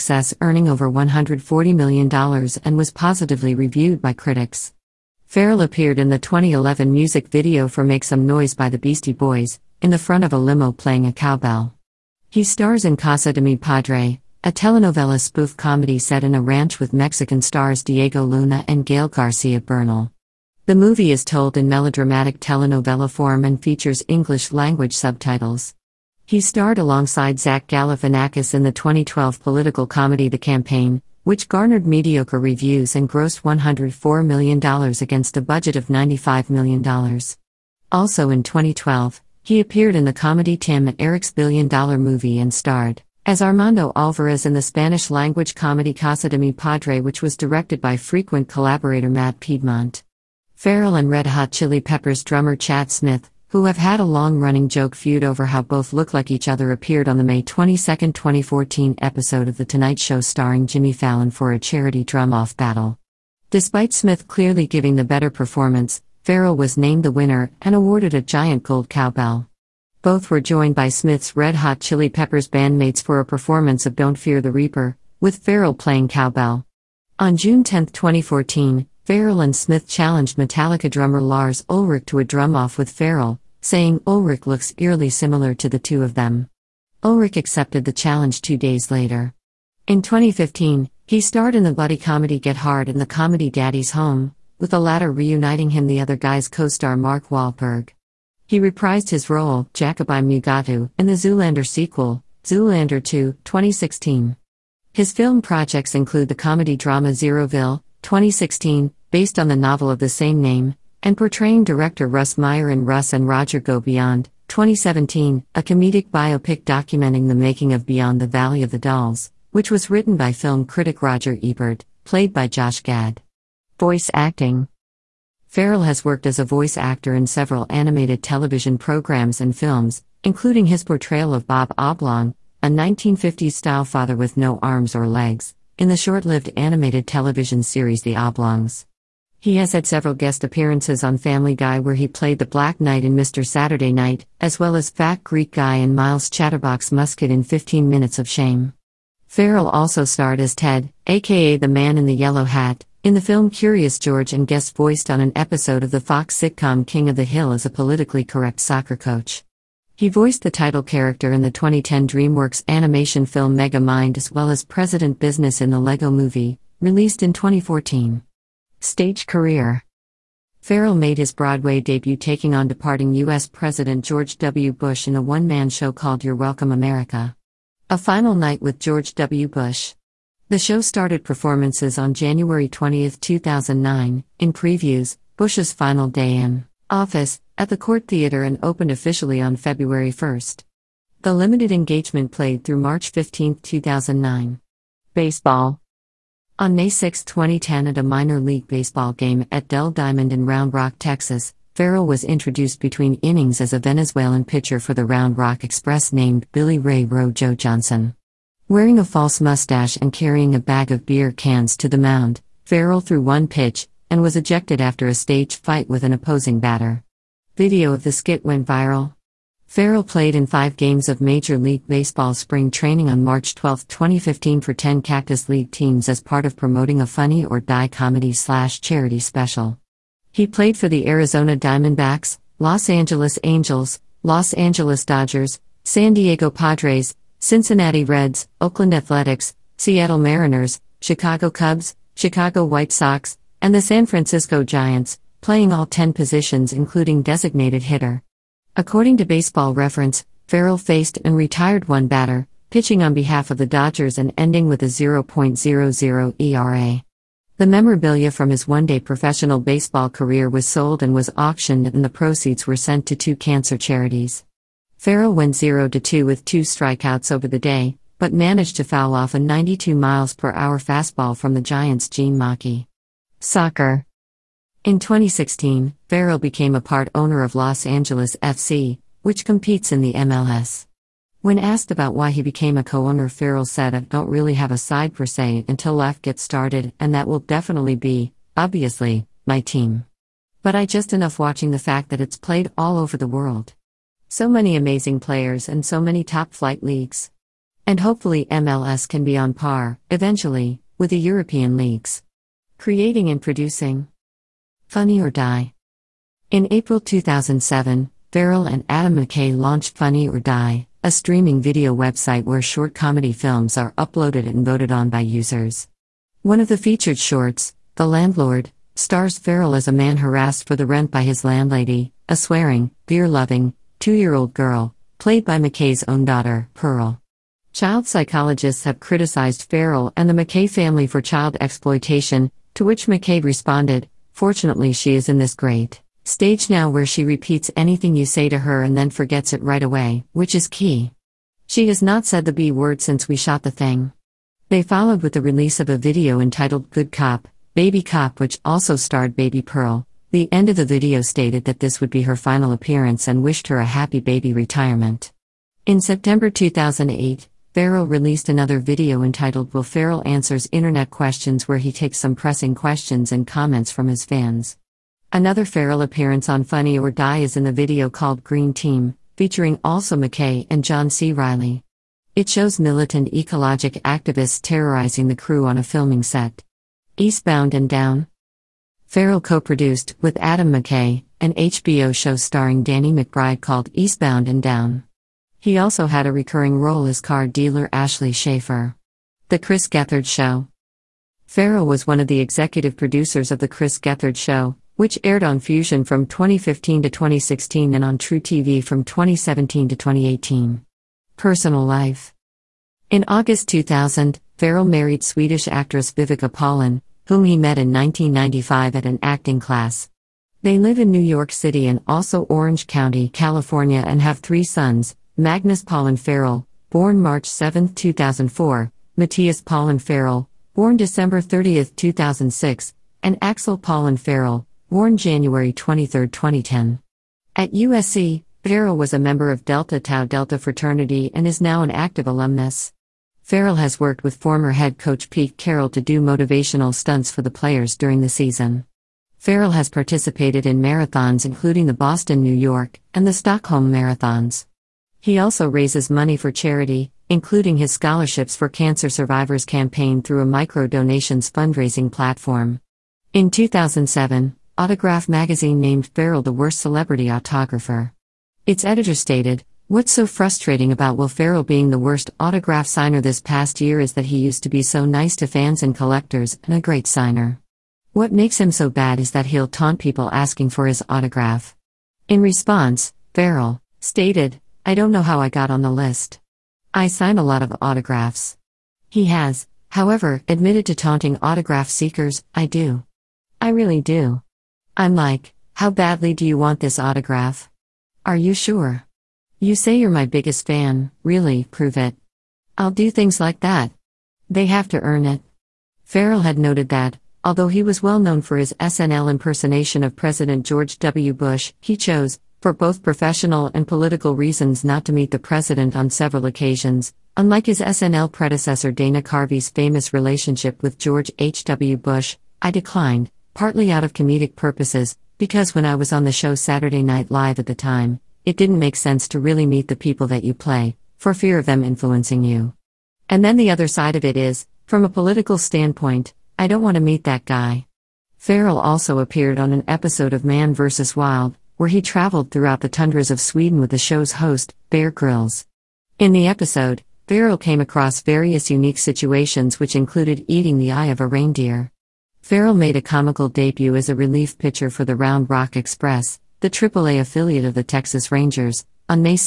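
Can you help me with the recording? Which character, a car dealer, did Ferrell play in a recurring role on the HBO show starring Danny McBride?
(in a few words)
Ashley Schaefer.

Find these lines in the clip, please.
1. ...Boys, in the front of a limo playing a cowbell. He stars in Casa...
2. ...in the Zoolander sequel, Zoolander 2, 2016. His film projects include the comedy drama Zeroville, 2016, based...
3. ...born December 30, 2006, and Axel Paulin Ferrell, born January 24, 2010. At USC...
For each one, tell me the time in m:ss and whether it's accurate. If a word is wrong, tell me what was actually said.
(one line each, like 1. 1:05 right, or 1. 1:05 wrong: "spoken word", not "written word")
1. 0:09 right
2. 1:40 right
3. 7:00 wrong: "23", not "24".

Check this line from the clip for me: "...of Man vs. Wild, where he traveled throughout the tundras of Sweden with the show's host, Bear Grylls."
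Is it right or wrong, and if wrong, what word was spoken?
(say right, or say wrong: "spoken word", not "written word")
right.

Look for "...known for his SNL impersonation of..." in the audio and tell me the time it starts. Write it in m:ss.
8:18.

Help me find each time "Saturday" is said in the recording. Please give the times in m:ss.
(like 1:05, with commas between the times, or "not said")
2:23, 8:36.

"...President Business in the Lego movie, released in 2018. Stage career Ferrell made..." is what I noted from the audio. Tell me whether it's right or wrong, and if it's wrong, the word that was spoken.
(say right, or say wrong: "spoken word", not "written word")
wrong: "2014", not "2018".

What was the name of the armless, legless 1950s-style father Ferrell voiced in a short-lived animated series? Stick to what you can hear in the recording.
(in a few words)
Bob Oblong.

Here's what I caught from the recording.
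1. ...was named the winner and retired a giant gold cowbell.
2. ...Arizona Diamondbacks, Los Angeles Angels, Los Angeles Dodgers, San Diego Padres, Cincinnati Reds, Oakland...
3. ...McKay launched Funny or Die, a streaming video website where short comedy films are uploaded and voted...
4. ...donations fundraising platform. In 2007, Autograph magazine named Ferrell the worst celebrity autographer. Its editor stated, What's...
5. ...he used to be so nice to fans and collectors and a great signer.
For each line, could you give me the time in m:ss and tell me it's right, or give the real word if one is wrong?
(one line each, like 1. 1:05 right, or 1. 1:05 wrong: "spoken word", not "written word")
1. 1:06 wrong: "awarded", not "retired"
2. 3:51 right
3. 5:09 right
4. 7:30 right
5. 7:44 right.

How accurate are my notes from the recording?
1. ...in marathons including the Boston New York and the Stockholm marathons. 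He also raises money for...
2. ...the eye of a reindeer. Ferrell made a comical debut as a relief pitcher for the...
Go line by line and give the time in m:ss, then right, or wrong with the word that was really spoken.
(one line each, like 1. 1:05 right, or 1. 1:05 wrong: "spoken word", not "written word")
1. 7:20 right
2. 9:00 right.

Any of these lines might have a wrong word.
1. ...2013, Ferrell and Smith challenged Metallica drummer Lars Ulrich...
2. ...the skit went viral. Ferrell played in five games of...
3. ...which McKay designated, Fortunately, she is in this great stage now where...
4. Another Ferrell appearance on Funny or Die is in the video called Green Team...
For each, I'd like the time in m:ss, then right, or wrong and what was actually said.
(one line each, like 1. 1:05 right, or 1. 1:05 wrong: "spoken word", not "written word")
1. 1:17 wrong: "2014", not "2013"
2. 3:38 right
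3. 5:32 wrong: "responded", not "designated"
4. 6:05 right.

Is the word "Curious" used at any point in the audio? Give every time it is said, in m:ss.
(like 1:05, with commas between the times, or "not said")
2:33.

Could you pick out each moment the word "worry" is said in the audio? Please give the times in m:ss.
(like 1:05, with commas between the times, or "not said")
not said.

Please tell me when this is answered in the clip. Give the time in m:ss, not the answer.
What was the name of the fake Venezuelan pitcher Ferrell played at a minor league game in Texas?
3:26.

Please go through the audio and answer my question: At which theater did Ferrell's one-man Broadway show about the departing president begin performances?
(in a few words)
Cort Theater.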